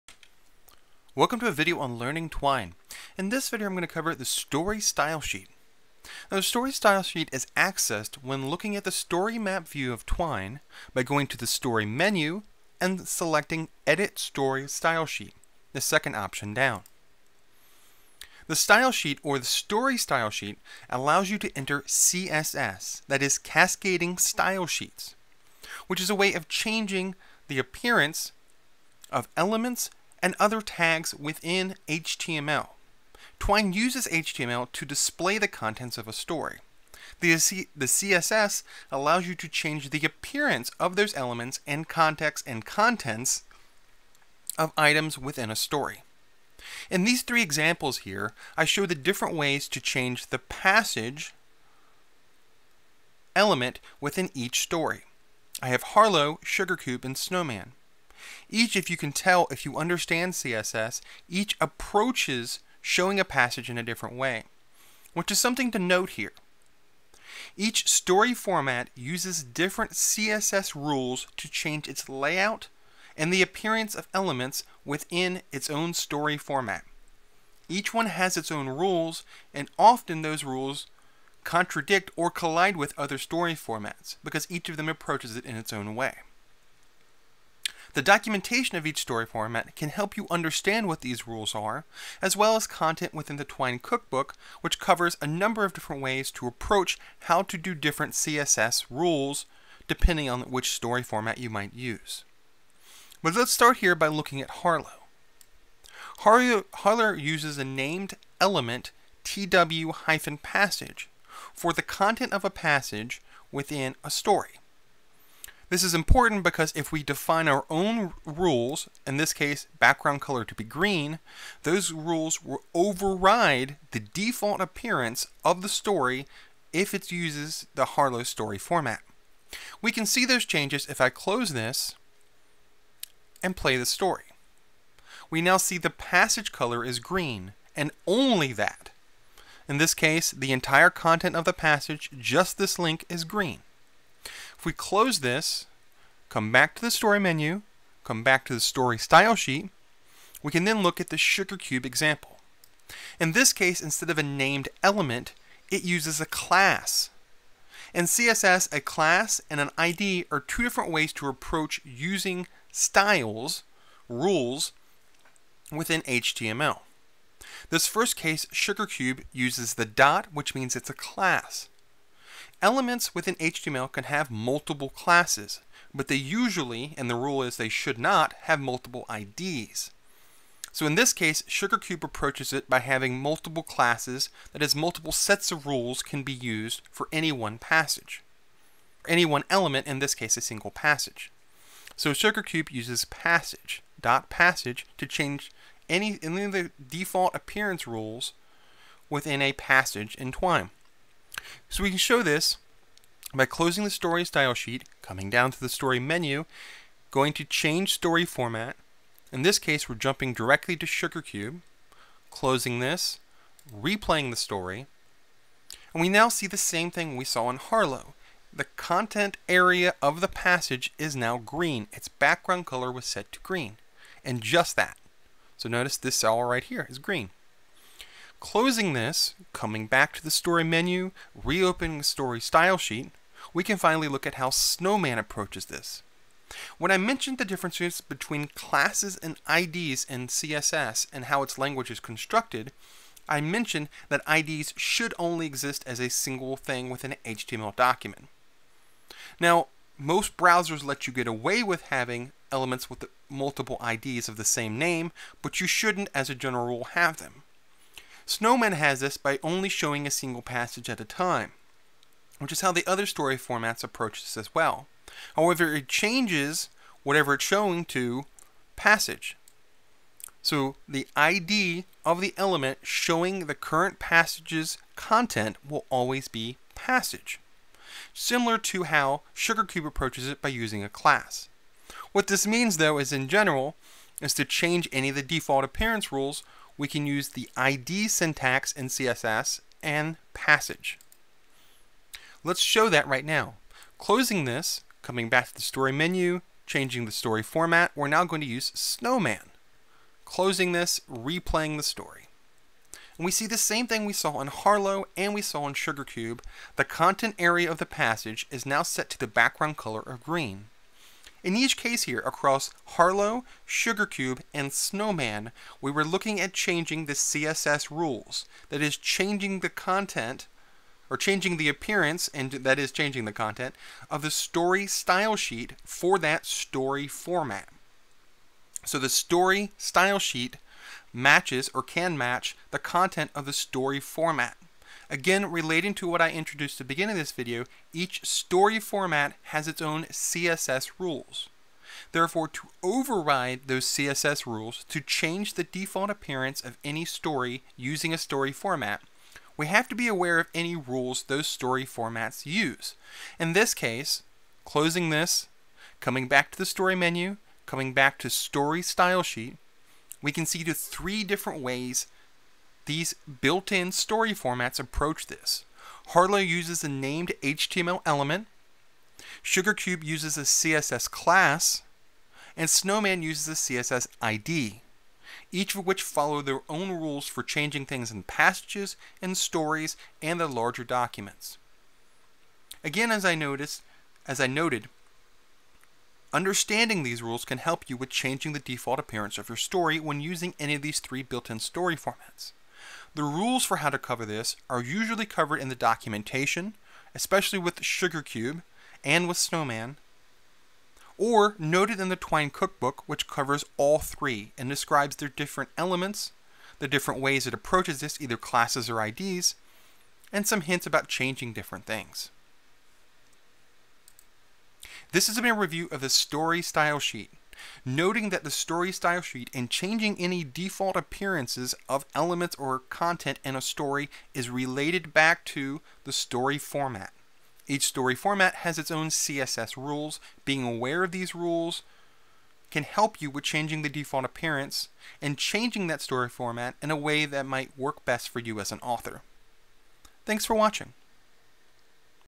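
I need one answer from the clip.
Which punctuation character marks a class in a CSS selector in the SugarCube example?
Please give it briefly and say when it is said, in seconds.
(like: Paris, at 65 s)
The dot, at 169 s.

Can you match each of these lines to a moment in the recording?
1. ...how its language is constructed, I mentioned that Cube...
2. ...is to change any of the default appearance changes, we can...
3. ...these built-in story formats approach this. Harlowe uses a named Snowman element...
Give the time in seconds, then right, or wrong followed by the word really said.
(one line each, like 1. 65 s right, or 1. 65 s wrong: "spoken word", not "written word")
1. 241 s wrong: "IDs", not "Cube"
2. 284 s wrong: "rules", not "changes"
3. 362 s wrong: "HTML", not "Snowman".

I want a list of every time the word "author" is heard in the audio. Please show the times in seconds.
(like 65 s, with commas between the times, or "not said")
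438 s.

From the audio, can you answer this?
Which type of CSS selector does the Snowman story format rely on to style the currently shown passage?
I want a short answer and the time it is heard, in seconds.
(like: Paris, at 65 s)
A CSS ID, at 373 s.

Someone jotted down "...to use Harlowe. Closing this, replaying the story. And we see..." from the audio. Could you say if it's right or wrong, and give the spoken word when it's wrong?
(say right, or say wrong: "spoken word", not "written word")
wrong: "Snowman", not "Harlowe".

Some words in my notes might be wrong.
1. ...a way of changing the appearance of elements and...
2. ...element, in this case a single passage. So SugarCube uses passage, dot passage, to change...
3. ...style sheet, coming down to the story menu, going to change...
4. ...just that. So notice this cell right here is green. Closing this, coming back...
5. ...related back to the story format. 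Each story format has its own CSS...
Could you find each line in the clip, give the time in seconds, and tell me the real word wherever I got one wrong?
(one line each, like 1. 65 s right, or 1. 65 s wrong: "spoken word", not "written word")
1. 26 s right
2. 189 s right
3. 204 s right
4. 224 s right
5. 424 s right.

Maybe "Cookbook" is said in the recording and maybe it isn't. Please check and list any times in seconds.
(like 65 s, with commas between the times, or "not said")
93 s, 402 s.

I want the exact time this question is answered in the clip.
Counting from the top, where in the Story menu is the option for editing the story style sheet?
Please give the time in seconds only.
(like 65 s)
15 s.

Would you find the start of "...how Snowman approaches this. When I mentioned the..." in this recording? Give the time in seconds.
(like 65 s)
234 s.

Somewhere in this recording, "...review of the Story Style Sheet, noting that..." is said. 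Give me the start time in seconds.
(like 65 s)
415 s.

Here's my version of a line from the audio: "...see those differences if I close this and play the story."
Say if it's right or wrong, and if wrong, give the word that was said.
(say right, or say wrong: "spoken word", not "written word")
wrong: "changes", not "differences".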